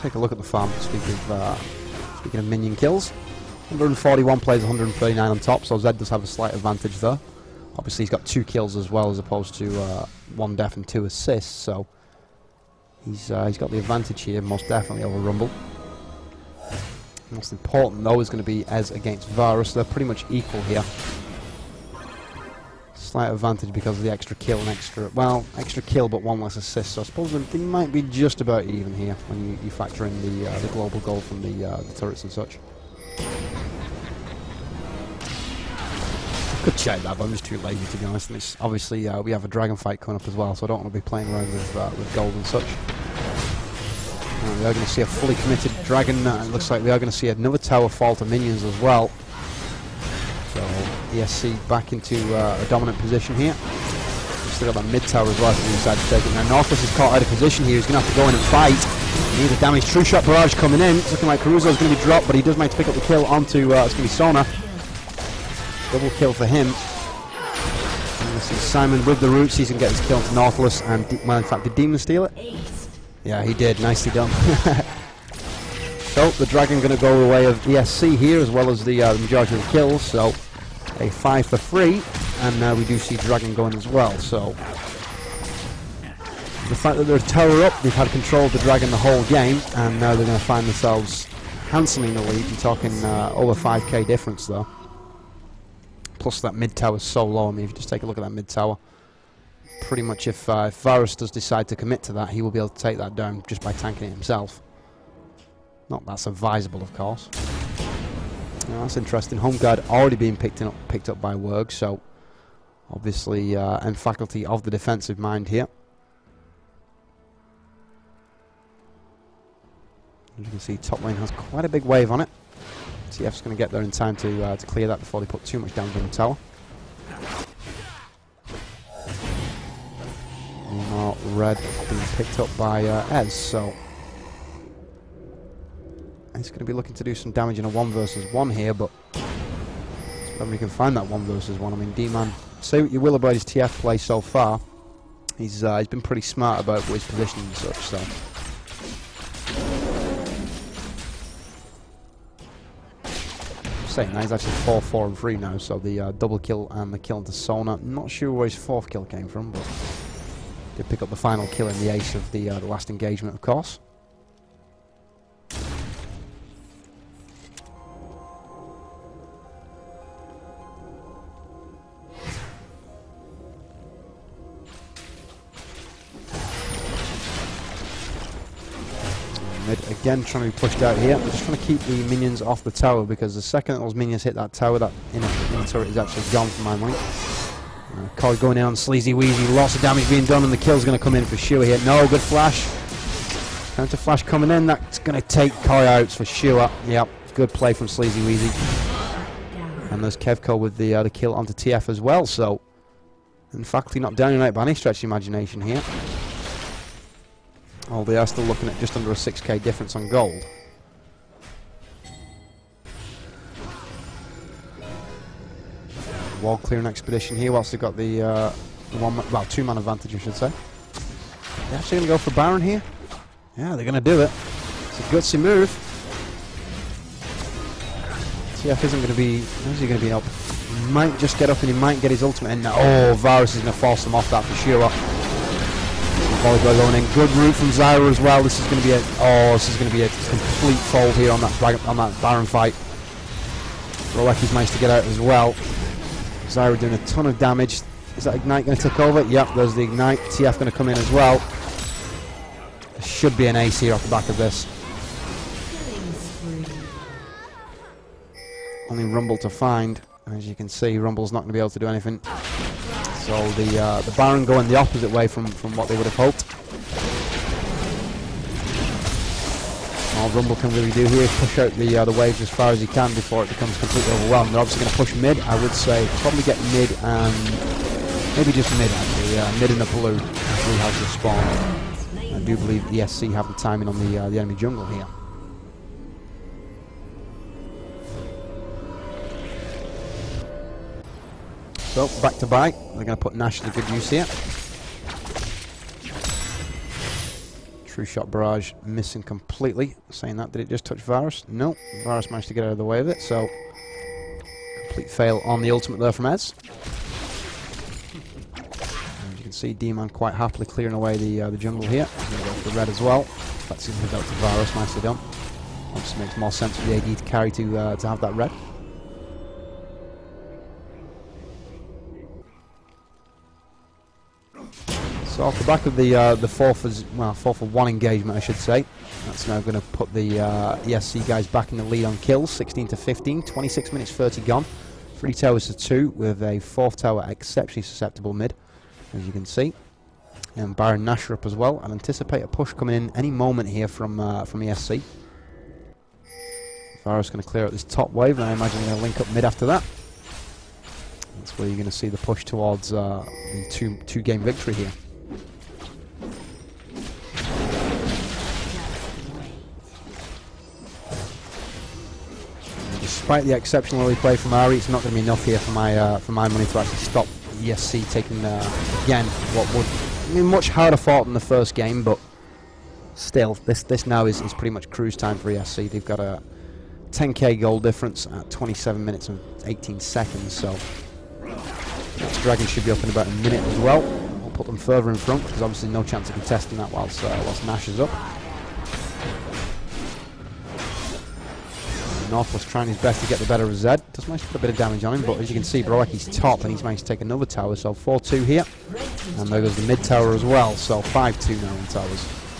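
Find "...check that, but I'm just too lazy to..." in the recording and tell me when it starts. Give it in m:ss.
0:36.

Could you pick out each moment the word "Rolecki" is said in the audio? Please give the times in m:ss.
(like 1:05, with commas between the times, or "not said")
4:04.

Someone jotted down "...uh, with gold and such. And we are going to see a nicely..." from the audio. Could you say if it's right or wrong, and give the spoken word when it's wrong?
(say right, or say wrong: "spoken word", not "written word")
wrong: "fully", not "nicely".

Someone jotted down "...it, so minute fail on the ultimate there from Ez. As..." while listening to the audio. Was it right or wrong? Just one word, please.
wrong.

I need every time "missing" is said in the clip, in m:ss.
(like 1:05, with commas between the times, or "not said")
4:58.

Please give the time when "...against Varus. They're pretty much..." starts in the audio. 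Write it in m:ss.
0:18.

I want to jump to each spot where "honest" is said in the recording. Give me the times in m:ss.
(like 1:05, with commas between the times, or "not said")
0:38.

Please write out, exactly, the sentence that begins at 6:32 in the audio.
North was trying his best to get the better of Zed.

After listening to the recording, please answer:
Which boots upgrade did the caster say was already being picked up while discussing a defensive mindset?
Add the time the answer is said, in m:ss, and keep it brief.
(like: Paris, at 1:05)
Home guard, at 1:49.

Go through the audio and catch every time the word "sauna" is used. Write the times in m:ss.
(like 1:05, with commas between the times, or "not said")
not said.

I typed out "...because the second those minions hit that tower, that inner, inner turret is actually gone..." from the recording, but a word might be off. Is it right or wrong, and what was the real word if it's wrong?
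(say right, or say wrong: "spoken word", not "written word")
right.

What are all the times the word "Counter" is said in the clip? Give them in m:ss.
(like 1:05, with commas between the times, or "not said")
3:13.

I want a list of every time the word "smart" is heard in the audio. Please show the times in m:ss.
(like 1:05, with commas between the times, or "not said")
2:26.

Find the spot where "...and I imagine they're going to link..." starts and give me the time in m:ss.
5:48.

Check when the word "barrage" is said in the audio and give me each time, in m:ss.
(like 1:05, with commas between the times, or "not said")
1:00, 4:58.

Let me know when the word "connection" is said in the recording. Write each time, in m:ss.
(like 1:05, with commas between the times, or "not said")
not said.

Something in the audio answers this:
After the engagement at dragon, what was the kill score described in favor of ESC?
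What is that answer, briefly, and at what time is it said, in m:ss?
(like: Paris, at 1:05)
5 for 3, at 1:21.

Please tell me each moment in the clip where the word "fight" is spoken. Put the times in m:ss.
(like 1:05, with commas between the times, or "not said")
0:39, 0:58, 4:02.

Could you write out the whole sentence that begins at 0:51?
ESC back into uh, a dominant position here.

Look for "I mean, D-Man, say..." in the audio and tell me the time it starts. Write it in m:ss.
2:21.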